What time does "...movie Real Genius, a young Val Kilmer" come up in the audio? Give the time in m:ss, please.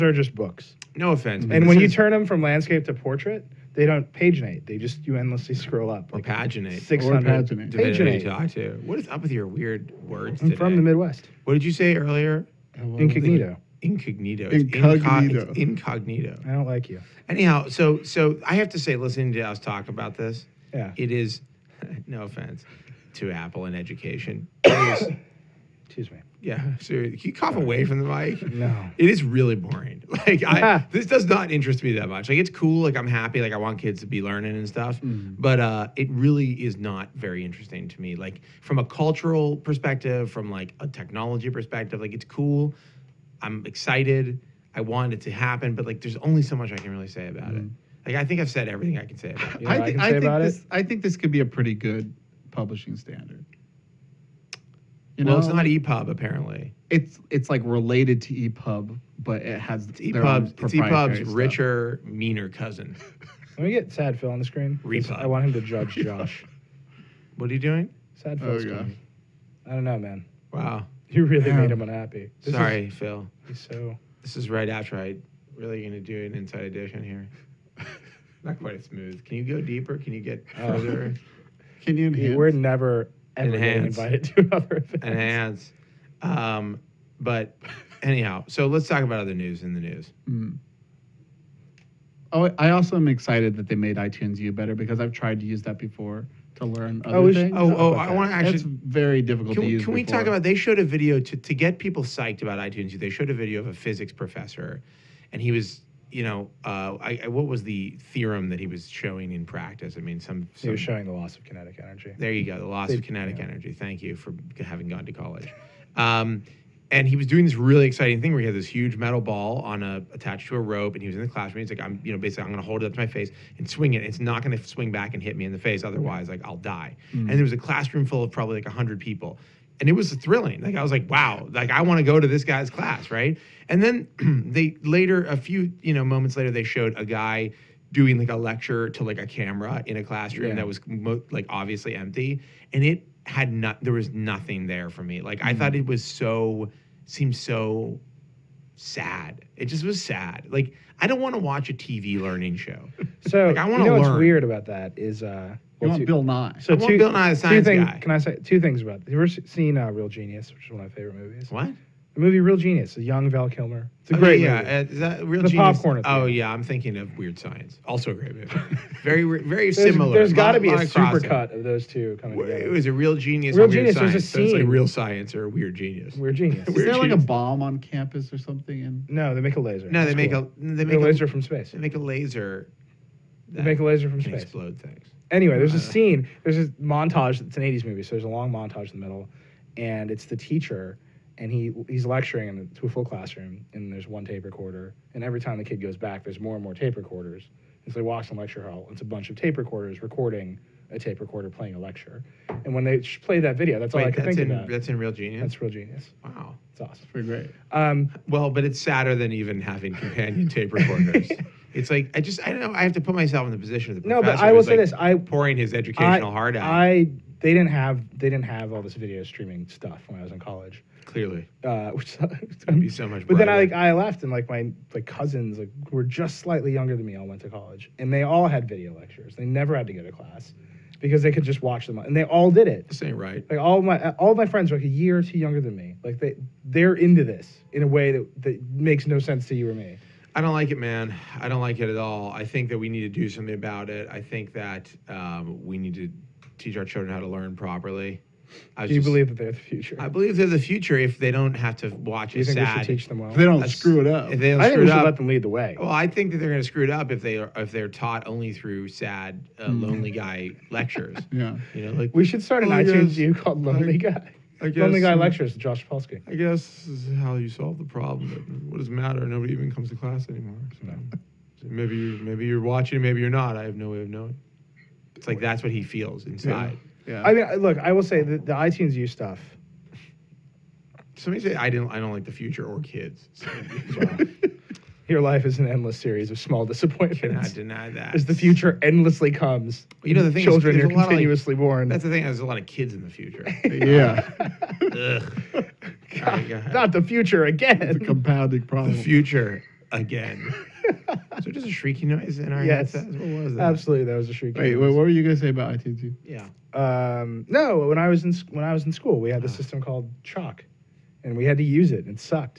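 2:42.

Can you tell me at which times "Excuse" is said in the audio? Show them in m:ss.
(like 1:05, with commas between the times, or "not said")
0:25.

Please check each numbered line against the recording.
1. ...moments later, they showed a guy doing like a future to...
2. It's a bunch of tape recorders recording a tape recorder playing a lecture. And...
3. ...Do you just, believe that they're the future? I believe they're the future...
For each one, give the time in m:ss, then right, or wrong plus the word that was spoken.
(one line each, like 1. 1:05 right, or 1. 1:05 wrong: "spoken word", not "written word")
1. 2:16 wrong: "lecture", not "future"
2. 3:18 right
3. 4:08 right.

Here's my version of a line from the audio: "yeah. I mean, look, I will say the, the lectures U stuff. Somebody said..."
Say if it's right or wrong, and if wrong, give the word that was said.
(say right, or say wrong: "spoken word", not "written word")
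wrong: "iTunes", not "lectures".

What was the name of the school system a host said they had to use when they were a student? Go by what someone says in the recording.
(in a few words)
Chalk.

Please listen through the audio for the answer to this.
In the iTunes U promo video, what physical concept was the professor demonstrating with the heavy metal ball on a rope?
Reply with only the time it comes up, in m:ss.
1:51.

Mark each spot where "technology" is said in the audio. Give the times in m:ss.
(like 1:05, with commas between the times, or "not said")
0:40.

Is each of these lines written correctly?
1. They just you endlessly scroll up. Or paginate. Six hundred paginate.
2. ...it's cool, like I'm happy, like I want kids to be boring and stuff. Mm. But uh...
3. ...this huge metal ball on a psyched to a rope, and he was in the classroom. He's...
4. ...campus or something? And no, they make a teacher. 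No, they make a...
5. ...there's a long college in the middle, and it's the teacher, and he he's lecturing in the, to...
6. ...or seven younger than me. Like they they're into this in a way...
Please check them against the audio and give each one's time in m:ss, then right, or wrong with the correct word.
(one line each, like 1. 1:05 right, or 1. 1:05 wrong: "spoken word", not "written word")
1. 0:04 right
2. 0:32 wrong: "learning", not "boring"
3. 1:58 wrong: "attached", not "psyched"
4. 2:57 wrong: "laser", not "teacher"
5. 3:08 wrong: "montage", not "college"
6. 3:55 wrong: "two", not "seven".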